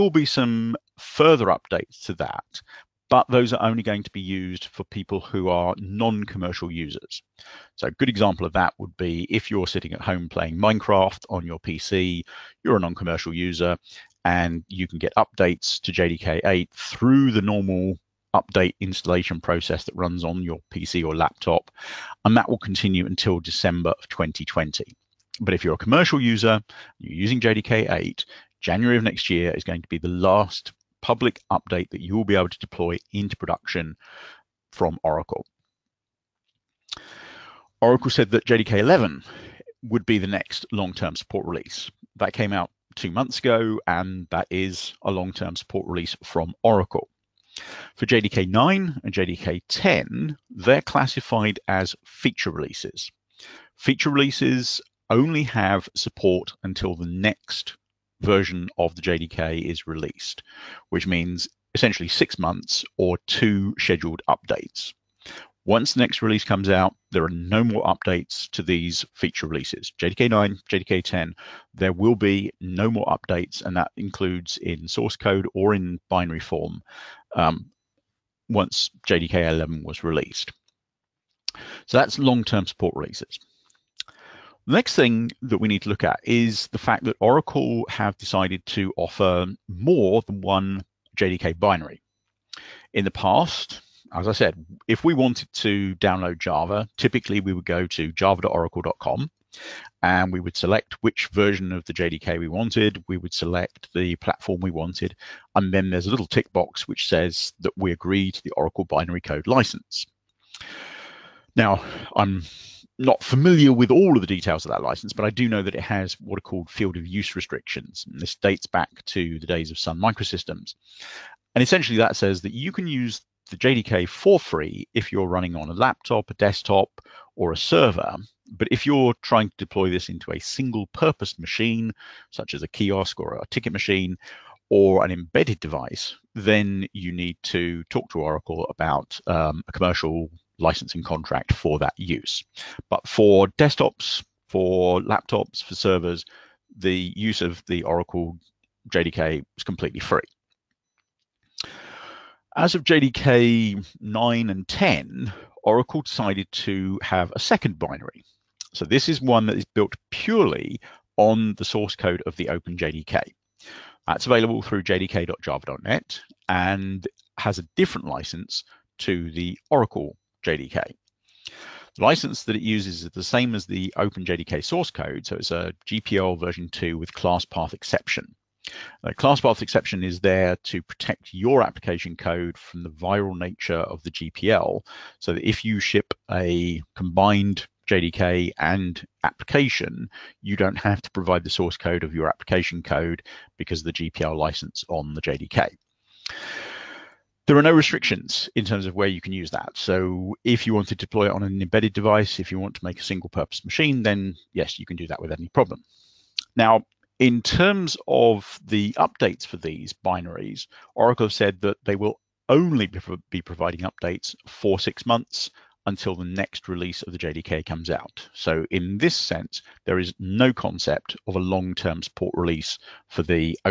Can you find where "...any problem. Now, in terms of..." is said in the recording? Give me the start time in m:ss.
3:25.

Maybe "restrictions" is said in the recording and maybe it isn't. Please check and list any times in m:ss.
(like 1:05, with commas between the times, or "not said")
1:57, 3:17.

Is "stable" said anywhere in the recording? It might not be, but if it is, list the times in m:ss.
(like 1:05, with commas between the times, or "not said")
not said.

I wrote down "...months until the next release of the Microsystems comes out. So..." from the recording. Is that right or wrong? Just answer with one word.
wrong.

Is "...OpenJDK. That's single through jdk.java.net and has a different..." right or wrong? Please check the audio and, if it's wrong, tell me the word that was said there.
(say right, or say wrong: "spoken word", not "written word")
wrong: "available", not "single".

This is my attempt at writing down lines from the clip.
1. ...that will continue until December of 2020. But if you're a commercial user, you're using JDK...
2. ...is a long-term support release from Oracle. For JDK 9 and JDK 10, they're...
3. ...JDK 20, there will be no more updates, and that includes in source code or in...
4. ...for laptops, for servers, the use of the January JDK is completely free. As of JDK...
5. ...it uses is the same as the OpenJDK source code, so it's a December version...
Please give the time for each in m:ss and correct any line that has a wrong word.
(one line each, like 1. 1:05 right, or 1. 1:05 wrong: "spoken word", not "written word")
1. 0:22 right
2. 0:44 right
3. 1:10 wrong: "10", not "20"
4. 2:24 wrong: "Oracle", not "January"
5. 2:52 wrong: "GPL", not "December".